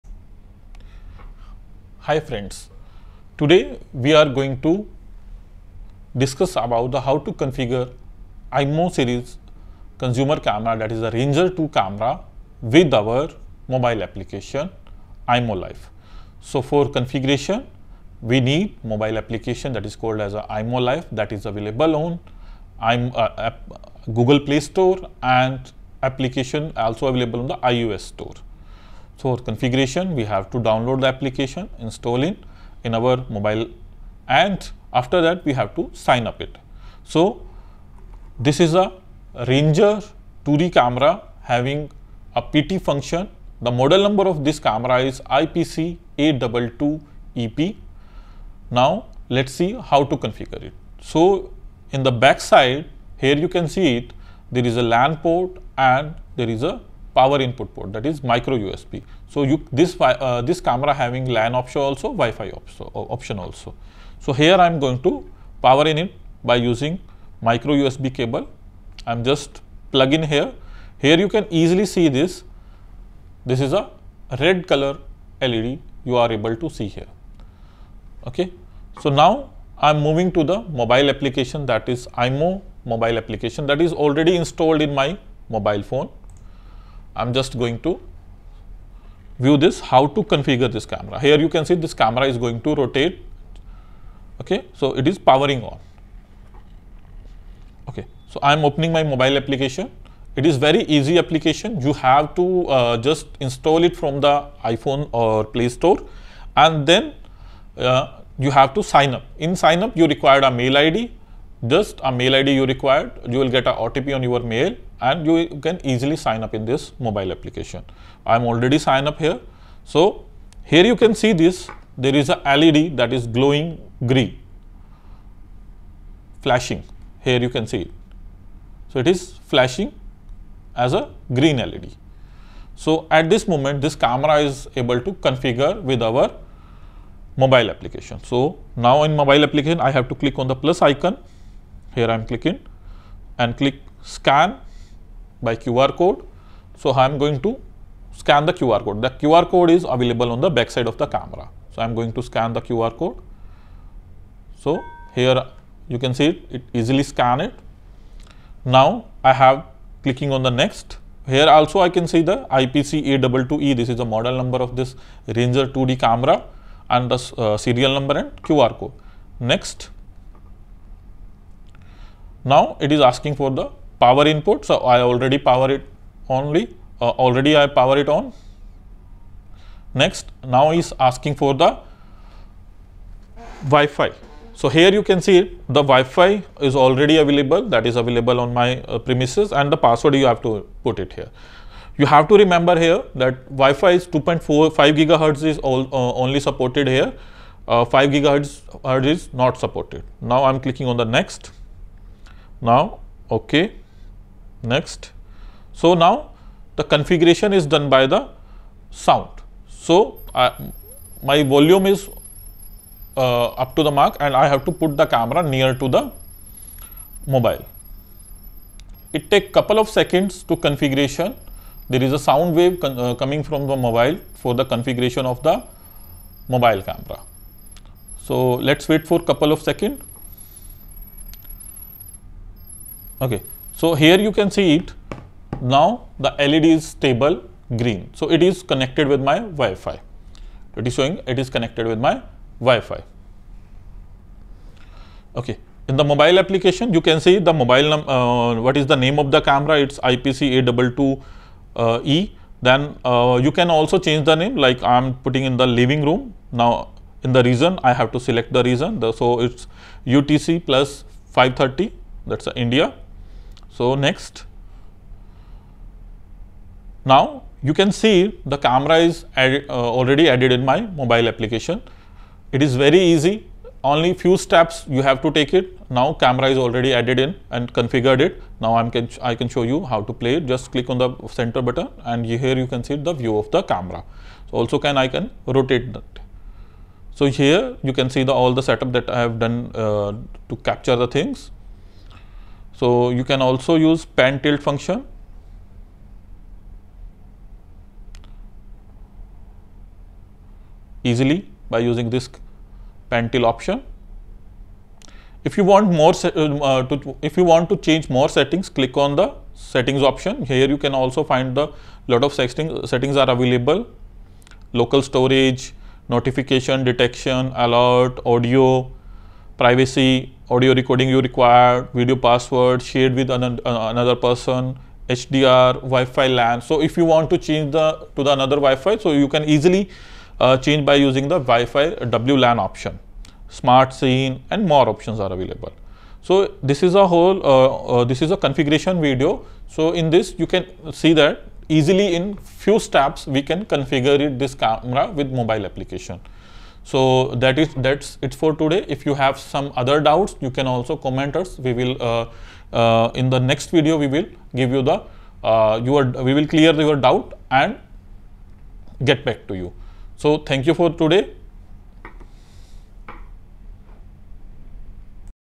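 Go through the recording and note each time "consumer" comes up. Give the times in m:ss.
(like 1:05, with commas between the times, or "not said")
0:09.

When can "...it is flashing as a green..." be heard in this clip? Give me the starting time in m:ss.
2:08.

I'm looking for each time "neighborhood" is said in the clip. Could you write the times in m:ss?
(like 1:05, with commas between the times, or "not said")
not said.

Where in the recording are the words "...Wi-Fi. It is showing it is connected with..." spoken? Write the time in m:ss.
3:59.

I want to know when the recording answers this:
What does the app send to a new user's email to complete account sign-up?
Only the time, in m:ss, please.
1:53.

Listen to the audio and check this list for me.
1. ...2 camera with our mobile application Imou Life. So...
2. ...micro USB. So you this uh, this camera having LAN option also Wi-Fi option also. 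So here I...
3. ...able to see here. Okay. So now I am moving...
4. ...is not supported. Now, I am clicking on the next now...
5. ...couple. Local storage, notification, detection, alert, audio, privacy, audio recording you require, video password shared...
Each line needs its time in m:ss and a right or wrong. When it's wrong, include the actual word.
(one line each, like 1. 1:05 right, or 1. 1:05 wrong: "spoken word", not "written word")
1. 0:11 right
2. 0:58 right
3. 1:16 right
4. 3:19 right
5. 5:13 wrong: "available", not "couple".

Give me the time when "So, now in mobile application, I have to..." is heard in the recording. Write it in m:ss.
2:18.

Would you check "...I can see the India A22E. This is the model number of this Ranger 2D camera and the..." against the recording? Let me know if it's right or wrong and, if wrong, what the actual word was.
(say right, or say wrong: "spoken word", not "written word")
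wrong: "IPC", not "India".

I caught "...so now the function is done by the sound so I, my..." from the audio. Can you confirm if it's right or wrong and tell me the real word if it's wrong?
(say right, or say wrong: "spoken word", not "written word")
wrong: "configuration", not "function".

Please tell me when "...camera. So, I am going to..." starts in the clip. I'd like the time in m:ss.
2:31.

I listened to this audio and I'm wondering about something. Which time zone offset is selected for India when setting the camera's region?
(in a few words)
UTC+5:30.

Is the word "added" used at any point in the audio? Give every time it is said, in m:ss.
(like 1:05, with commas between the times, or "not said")
4:30, 4:36.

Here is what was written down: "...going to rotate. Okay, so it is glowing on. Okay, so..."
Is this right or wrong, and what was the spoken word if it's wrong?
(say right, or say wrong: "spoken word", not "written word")
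wrong: "powering", not "glowing".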